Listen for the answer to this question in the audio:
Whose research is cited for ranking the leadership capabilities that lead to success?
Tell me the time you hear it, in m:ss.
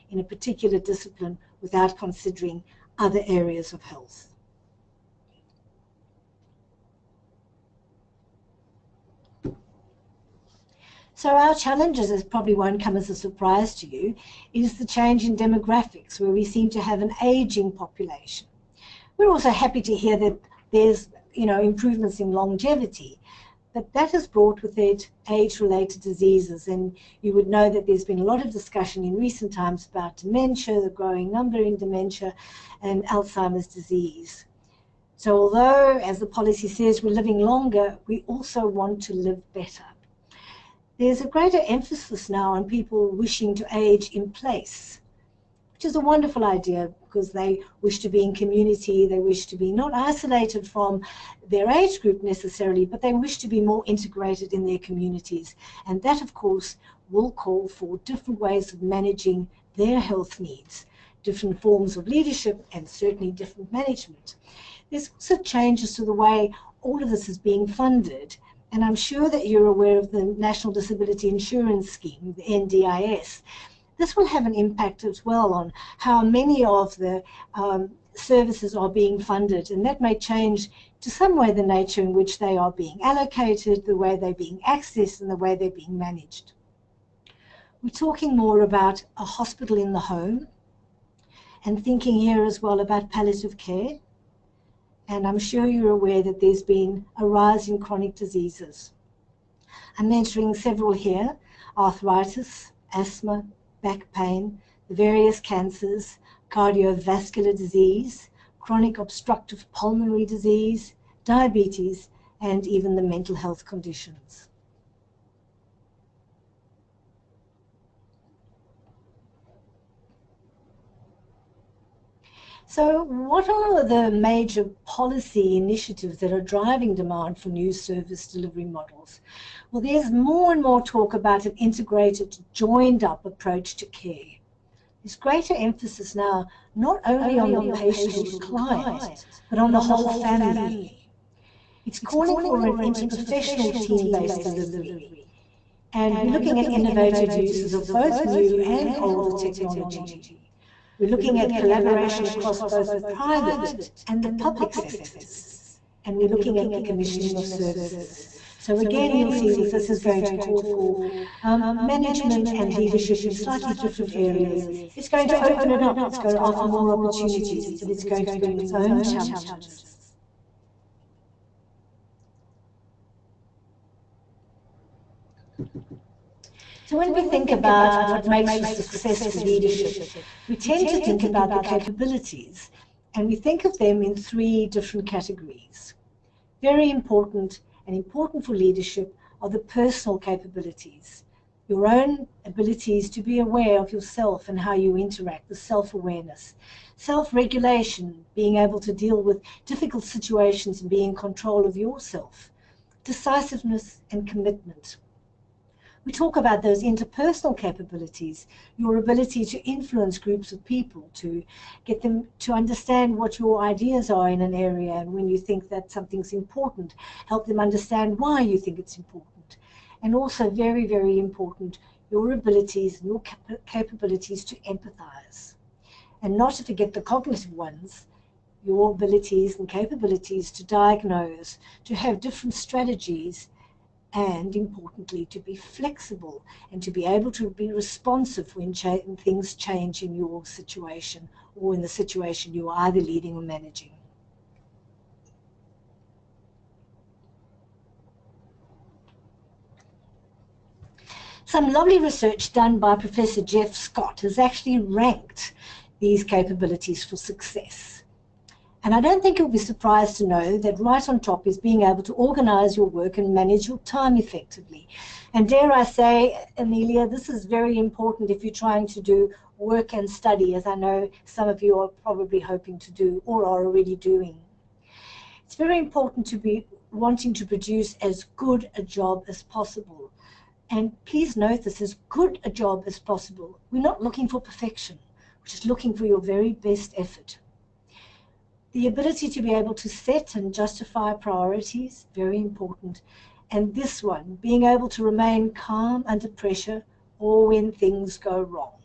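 4:12.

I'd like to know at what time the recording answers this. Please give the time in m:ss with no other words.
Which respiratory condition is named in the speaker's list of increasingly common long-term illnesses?
1:48.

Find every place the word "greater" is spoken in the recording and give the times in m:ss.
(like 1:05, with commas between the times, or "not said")
0:41, 2:15.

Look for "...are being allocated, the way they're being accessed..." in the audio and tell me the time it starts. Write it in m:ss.
1:22.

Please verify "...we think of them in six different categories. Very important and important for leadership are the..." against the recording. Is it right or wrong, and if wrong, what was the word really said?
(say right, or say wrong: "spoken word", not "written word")
wrong: "three", not "six".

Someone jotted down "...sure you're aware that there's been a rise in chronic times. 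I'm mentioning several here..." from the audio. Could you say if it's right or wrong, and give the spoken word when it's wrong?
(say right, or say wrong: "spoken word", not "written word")
wrong: "diseases", not "times".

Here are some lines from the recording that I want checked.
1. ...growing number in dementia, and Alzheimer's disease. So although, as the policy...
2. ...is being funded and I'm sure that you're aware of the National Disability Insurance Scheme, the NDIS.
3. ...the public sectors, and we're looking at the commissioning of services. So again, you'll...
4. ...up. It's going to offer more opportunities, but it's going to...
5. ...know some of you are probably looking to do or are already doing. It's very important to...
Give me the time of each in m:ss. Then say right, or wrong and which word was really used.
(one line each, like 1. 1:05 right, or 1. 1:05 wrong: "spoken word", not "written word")
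1. 0:30 right
2. 1:07 right
3. 2:34 right
4. 2:45 right
5. 4:30 wrong: "hoping", not "looking".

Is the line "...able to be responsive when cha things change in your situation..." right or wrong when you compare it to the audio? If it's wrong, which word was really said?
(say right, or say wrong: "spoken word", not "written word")
right.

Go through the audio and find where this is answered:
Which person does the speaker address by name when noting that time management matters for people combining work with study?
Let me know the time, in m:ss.
4:26.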